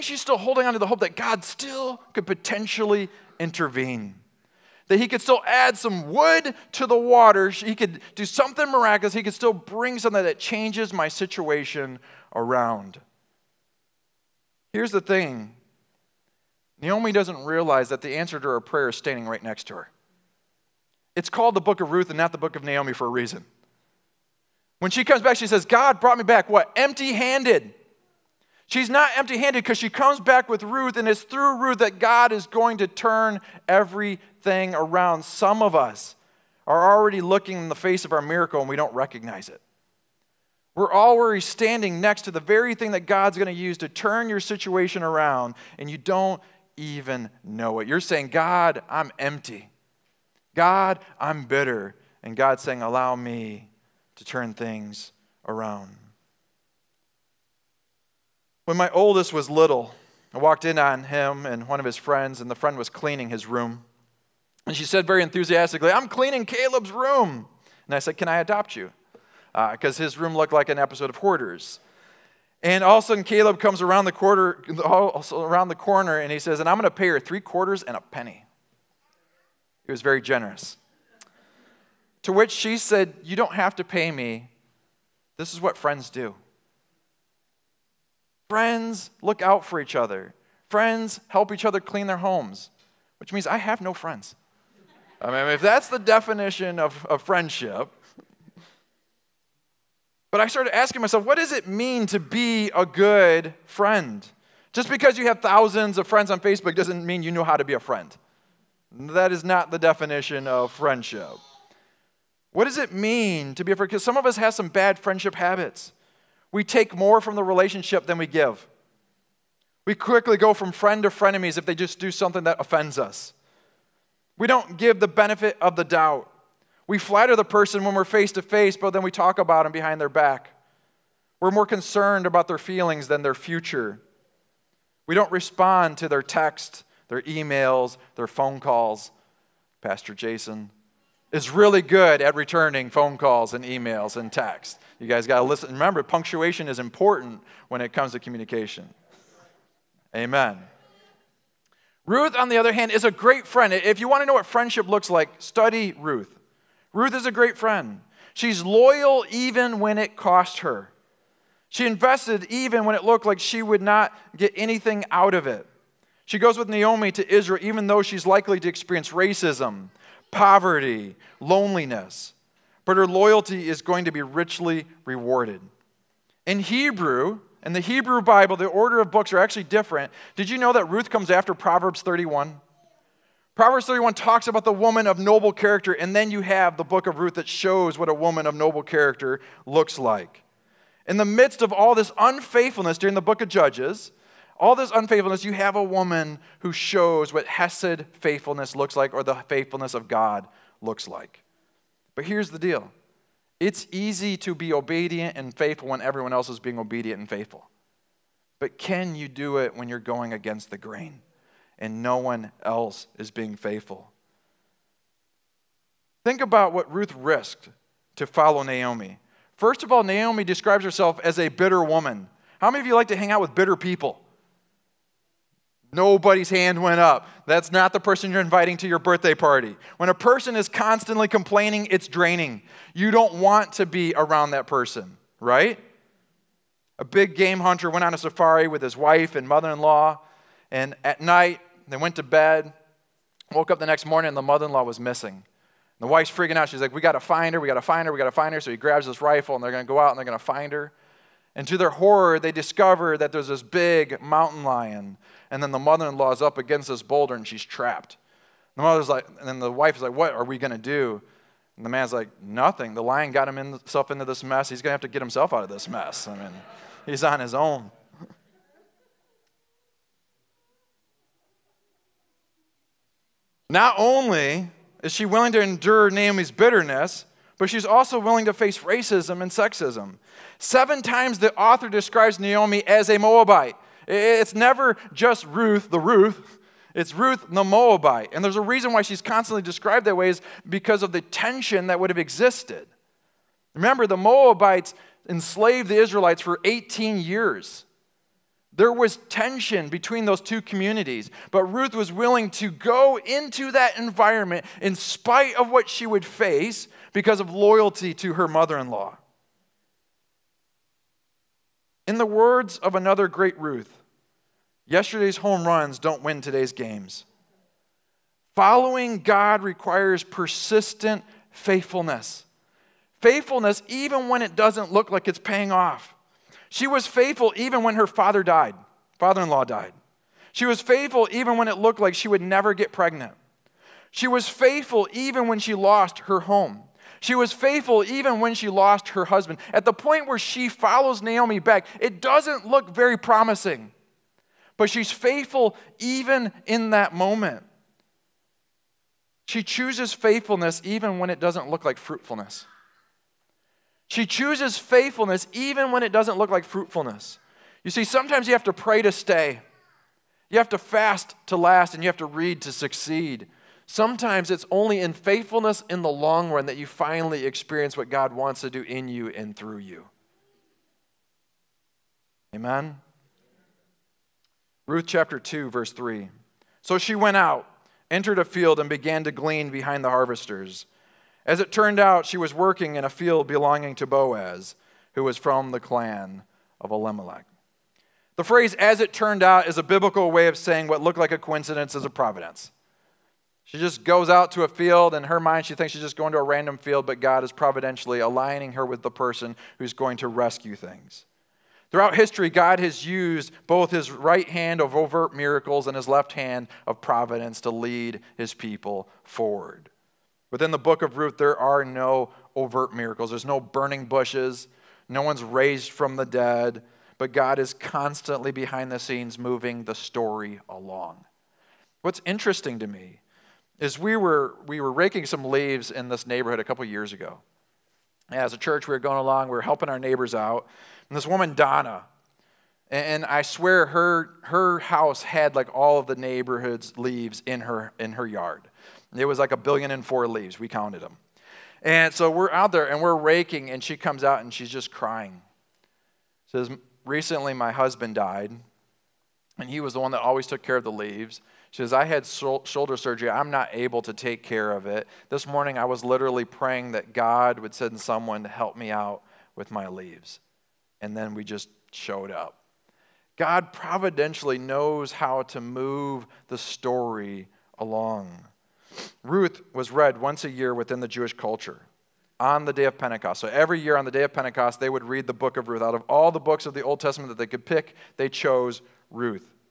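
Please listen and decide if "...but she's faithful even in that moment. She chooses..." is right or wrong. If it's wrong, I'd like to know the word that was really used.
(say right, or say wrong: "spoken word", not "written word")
right.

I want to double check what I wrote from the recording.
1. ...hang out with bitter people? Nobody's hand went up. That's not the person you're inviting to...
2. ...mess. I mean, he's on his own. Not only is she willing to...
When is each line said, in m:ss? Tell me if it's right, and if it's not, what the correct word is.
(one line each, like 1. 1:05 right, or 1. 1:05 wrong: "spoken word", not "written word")
1. 3:43 right
2. 4:25 right.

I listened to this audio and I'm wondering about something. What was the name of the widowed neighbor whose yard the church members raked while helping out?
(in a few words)
Donna.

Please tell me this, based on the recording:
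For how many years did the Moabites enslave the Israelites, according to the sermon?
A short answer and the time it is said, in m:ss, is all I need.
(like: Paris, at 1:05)
18, at 4:56.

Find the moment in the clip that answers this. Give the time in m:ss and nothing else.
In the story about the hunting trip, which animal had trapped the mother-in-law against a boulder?
4:14.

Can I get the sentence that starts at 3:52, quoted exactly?
You don't want to be around that person, right?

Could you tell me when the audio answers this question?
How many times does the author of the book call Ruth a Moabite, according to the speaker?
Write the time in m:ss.
4:40.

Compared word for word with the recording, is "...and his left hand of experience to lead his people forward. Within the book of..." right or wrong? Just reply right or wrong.
wrong.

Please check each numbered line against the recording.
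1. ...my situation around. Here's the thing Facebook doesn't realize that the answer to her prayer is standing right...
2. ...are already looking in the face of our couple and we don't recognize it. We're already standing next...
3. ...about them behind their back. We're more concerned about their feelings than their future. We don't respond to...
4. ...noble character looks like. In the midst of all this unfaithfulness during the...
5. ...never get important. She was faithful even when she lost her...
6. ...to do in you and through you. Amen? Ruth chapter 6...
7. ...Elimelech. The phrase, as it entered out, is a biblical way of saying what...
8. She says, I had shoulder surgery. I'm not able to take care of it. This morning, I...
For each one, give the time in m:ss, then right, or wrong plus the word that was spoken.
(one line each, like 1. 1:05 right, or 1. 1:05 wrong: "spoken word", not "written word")
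1. 0:10 wrong: "Naomi", not "Facebook"
2. 0:36 wrong: "miracle", not "couple"
3. 2:09 right
4. 3:08 right
5. 5:32 wrong: "pregnant", not "important"
6. 6:08 wrong: "2", not "6"
7. 6:26 wrong: "turned", not "entered"
8. 7:31 right.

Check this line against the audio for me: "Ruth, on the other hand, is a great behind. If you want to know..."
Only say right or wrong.
wrong.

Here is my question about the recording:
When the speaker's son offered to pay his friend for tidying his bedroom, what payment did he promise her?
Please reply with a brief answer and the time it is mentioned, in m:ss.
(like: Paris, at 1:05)
three quarters and a penny, at 1:17.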